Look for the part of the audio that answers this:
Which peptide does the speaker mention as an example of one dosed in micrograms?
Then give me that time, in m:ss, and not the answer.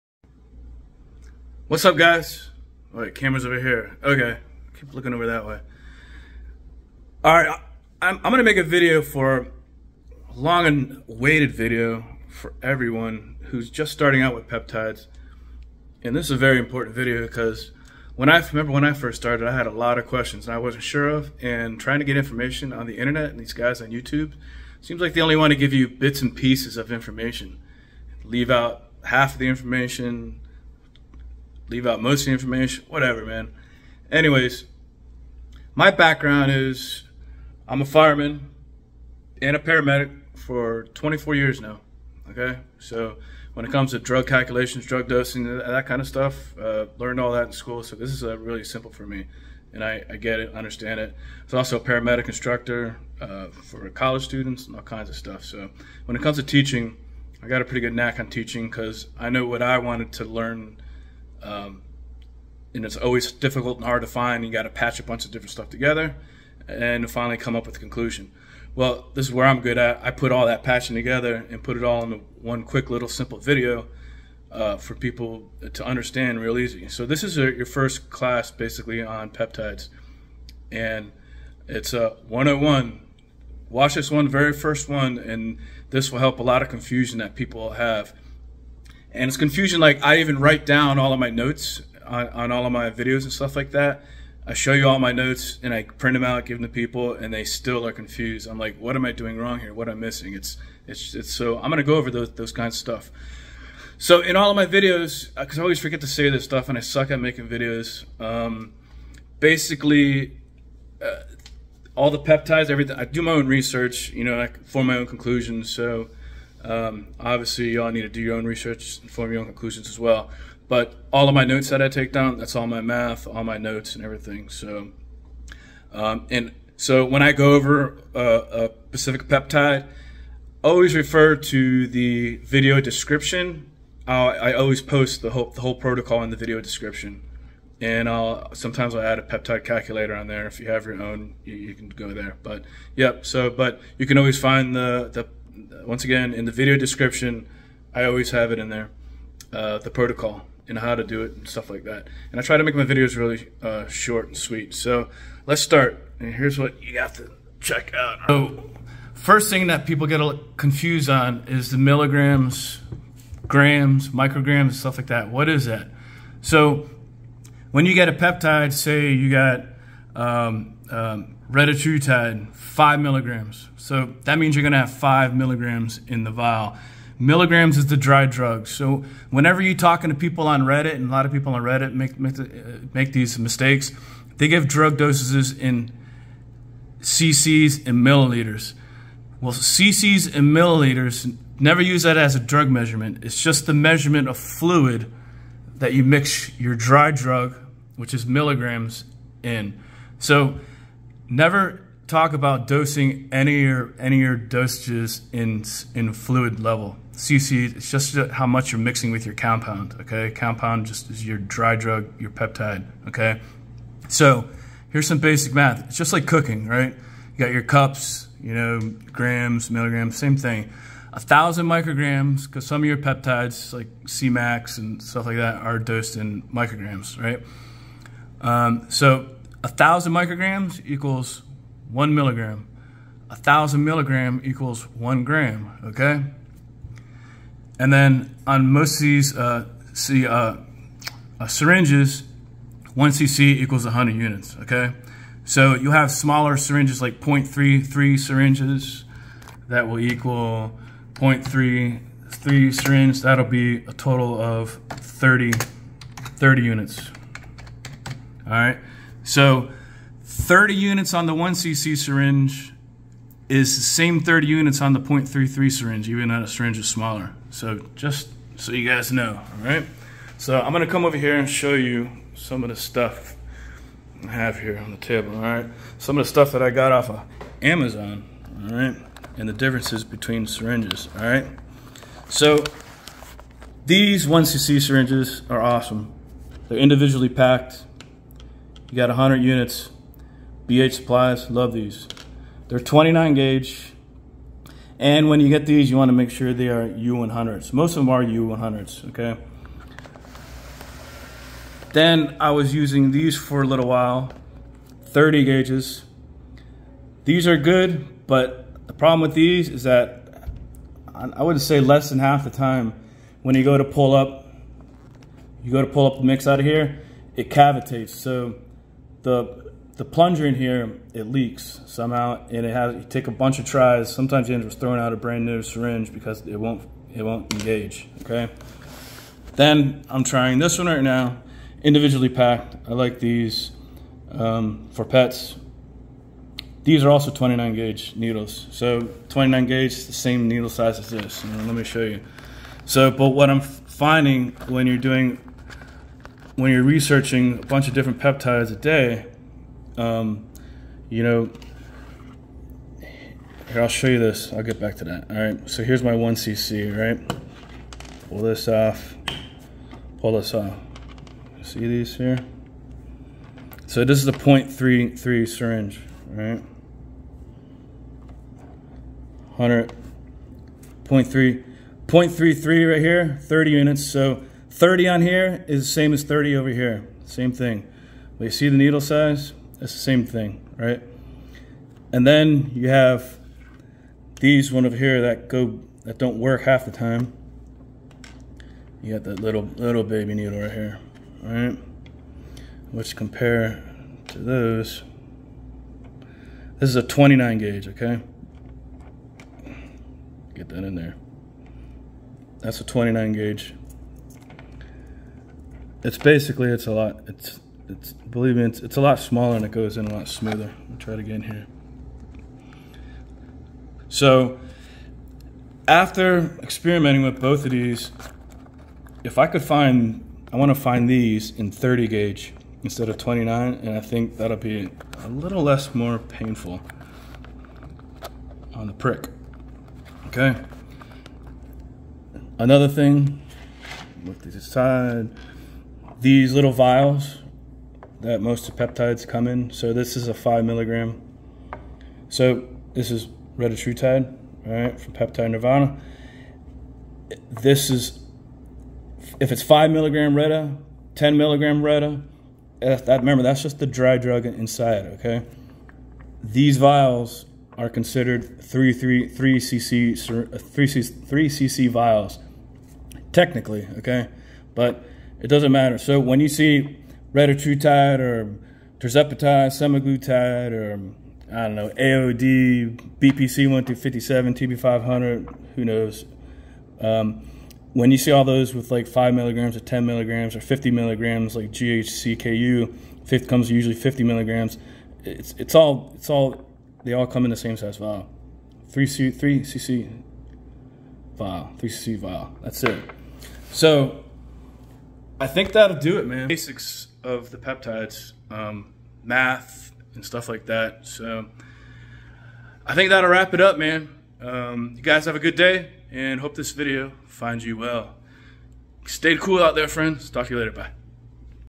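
3:44.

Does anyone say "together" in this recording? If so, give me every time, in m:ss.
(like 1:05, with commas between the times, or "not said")
1:05, 1:10.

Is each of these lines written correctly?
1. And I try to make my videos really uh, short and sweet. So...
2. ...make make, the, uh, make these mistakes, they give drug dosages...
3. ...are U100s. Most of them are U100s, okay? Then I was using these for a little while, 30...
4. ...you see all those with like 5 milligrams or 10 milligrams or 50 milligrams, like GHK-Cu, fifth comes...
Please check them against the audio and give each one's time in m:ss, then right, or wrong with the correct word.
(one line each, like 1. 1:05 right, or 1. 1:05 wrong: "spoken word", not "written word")
1. 2:32 right
2. 3:01 right
3. 4:56 right
4. 7:58 right.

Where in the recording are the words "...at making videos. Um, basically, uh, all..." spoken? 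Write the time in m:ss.
1:47.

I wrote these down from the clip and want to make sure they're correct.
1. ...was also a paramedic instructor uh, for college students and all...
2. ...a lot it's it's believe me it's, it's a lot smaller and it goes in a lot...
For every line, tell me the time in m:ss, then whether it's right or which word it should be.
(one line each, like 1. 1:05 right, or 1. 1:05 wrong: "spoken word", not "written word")
1. 0:51 right
2. 6:46 right.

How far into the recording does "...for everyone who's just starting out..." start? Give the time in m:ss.
0:12.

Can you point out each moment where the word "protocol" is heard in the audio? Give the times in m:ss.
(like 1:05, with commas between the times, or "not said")
2:15, 2:29.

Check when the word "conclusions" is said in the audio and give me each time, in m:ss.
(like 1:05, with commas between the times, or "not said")
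1:07, 1:55, 1:59.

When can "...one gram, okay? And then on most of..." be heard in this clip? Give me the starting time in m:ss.
3:54.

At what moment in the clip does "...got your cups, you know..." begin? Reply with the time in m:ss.
3:37.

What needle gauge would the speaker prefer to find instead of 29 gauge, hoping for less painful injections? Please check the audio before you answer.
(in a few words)
30 gauge.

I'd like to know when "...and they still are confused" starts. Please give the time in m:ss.
1:37.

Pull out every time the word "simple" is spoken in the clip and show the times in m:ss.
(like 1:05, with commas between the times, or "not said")
0:48, 1:13.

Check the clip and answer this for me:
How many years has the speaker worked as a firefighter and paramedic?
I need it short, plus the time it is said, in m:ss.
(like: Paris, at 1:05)
24, at 0:40.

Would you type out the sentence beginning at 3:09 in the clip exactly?
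Well, cc's and milliliters never use that as a drug measurement.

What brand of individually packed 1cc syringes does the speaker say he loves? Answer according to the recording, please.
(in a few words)
BH Supplies.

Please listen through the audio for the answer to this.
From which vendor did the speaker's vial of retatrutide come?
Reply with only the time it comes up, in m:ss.
7:25.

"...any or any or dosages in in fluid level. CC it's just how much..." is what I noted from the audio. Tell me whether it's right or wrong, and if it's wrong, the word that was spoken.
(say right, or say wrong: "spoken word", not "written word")
right.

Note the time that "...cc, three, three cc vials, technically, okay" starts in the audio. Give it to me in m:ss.
7:39.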